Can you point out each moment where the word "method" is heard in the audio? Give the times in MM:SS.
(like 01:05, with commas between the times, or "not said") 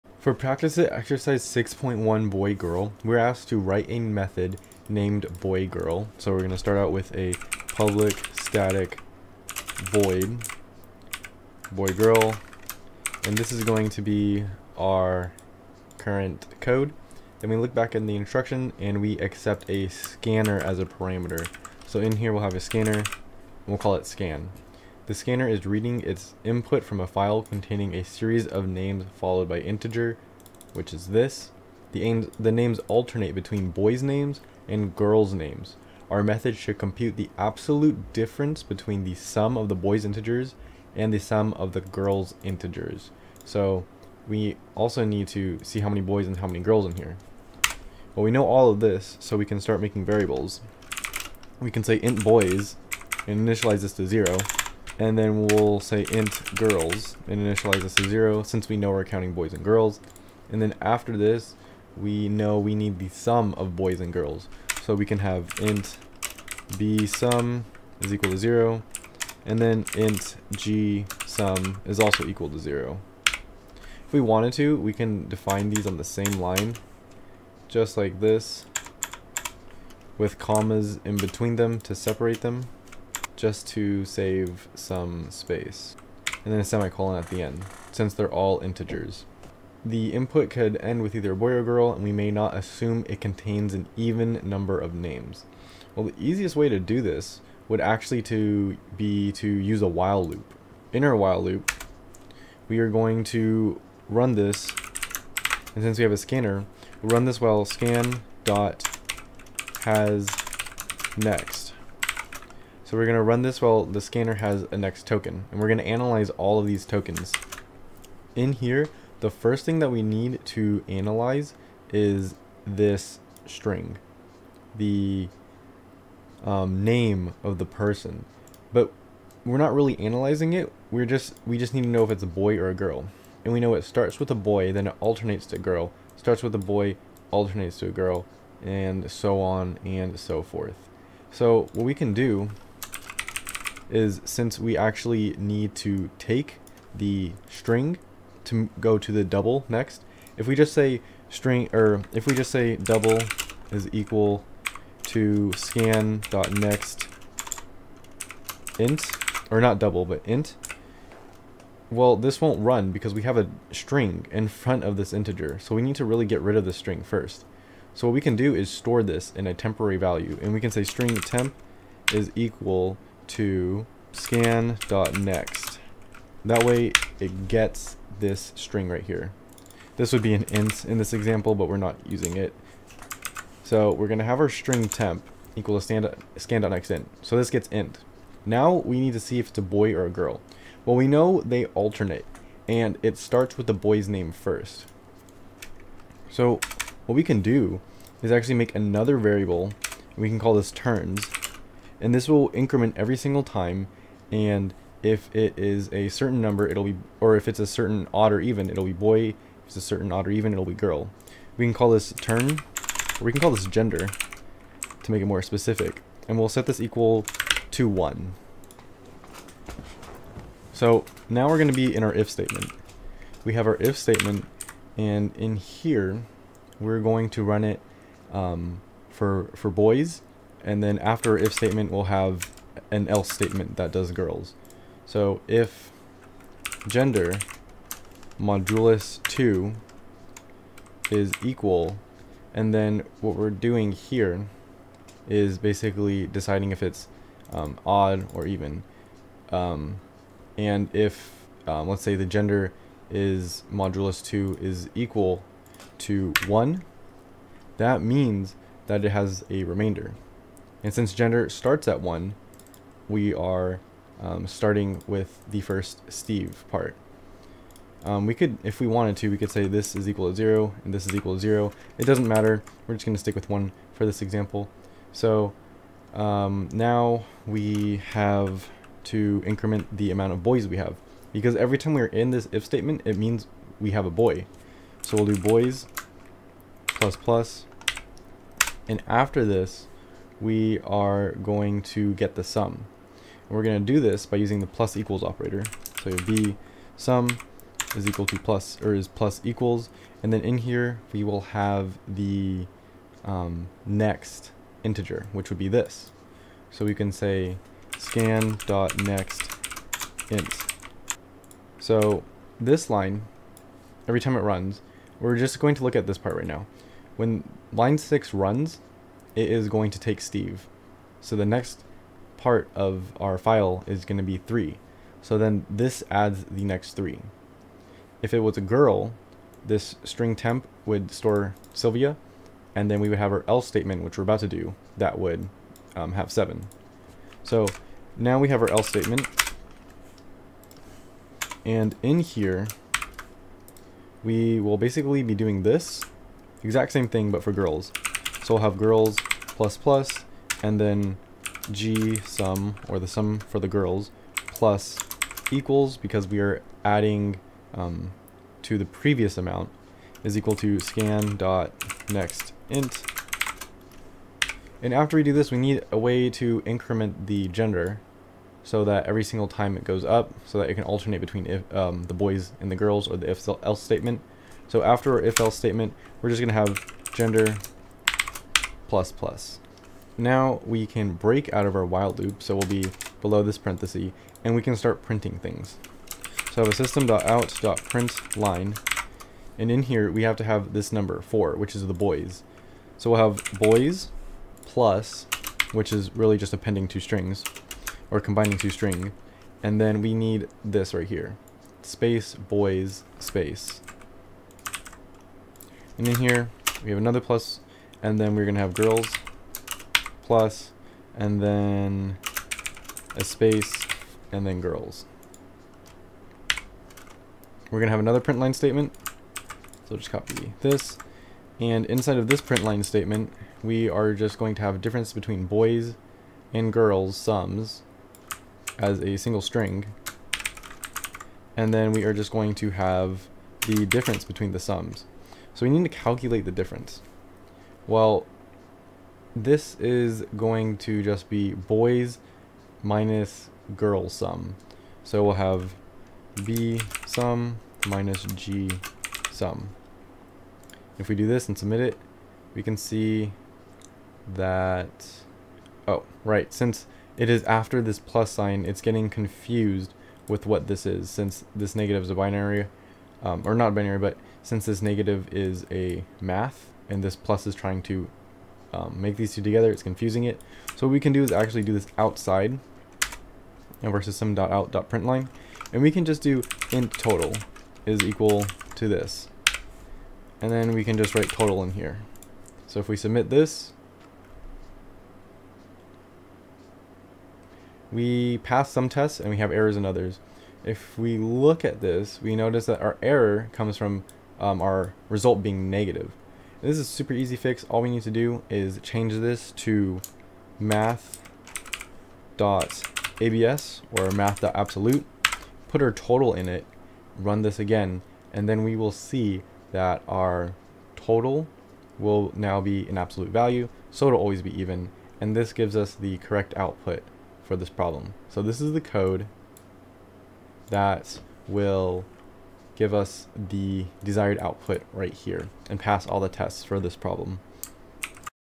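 00:03, 00:36.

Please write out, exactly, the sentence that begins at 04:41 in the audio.
Because every time we're in this if statement, it means we have a boy.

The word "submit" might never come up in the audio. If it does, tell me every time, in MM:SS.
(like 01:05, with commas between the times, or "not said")
07:31, 08:02.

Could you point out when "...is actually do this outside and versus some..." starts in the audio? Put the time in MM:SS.
07:51.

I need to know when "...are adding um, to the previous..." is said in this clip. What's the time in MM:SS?
05:56.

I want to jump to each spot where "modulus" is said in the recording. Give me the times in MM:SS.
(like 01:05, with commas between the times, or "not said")
03:58, 04:13.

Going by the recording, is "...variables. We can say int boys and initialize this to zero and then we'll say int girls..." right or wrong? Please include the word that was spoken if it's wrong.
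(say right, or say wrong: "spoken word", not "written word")
right.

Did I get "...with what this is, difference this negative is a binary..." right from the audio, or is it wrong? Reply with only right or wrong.
wrong.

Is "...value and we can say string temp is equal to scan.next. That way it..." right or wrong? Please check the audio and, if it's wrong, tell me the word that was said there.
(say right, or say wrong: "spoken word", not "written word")
right.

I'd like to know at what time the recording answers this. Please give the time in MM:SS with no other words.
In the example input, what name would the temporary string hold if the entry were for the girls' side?
05:31.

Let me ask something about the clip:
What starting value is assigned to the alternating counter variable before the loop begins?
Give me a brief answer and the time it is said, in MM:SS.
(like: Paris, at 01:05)
1, at 03:36.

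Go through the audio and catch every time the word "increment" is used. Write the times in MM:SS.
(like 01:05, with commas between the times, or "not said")
03:22, 04:39, 06:06.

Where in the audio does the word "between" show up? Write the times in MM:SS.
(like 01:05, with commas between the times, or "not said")
00:33, 00:38, 01:21, 06:11, 07:05, 07:14.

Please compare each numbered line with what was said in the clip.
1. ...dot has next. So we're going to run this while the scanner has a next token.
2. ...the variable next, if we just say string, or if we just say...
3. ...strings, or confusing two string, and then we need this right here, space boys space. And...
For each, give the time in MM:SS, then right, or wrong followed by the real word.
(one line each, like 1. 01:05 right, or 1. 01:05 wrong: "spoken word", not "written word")
1. 01:48 right
2. 02:29 wrong: "double", not "variable"
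3. 06:36 wrong: "combining", not "confusing".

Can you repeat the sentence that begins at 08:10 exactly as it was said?
If we look at this, we notice that our error comes from um, our result being negative.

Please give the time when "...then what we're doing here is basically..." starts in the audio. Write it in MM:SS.
04:02.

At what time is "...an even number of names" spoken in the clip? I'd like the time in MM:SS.
01:33.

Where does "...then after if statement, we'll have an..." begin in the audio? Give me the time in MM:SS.
03:50.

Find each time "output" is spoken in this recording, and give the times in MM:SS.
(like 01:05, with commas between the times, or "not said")
08:36, 08:44.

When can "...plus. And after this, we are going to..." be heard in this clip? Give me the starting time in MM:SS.
04:47.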